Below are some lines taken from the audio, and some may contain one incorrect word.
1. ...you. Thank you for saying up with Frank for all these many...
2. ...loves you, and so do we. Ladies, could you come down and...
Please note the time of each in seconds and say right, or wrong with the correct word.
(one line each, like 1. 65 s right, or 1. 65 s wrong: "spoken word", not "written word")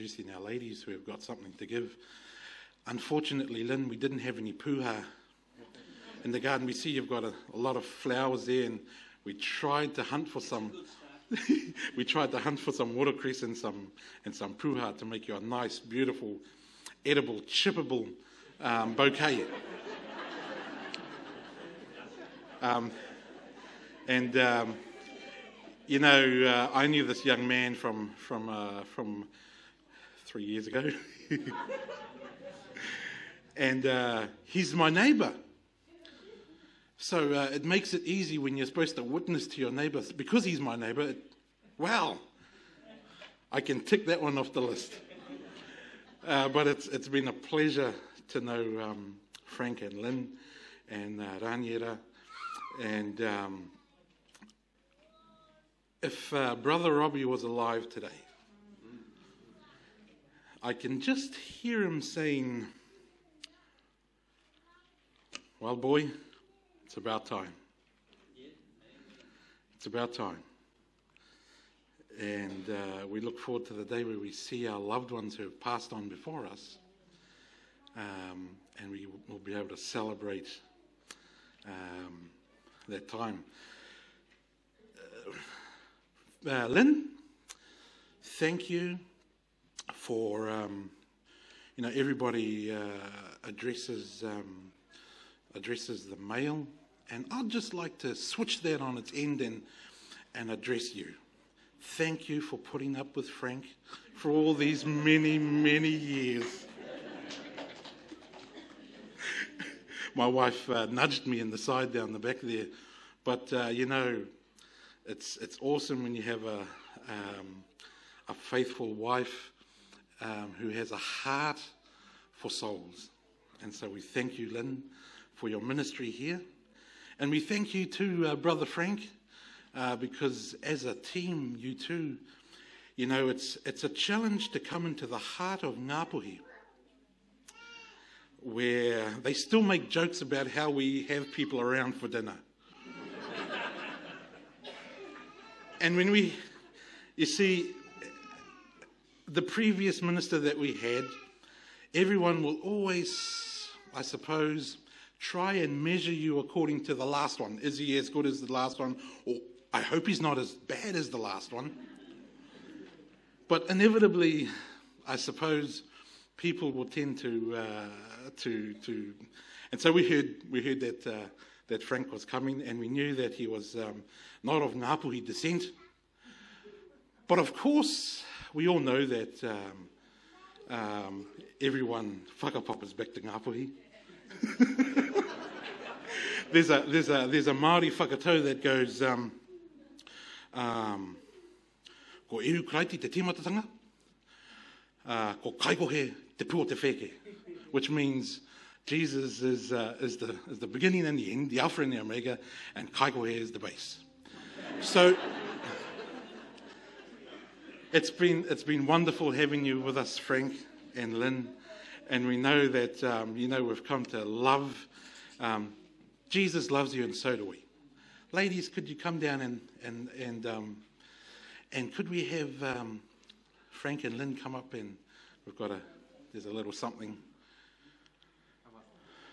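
1. 100 s wrong: "putting", not "saying"
2. 216 s right.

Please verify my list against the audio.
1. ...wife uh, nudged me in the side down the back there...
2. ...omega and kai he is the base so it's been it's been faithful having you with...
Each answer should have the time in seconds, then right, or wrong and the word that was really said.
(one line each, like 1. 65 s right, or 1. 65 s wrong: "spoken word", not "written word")
1. 110 s right
2. 202 s wrong: "wonderful", not "faithful".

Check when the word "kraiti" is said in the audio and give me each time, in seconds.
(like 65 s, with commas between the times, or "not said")
192 s.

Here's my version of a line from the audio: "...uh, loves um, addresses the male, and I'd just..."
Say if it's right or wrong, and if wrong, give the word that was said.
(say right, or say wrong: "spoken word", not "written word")
wrong: "addresses", not "loves".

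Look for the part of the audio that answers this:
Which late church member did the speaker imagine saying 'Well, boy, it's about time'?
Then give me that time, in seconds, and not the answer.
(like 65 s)
56 s.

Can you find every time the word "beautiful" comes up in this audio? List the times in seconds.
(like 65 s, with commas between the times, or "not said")
15 s.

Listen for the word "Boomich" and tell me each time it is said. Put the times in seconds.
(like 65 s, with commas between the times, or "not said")
not said.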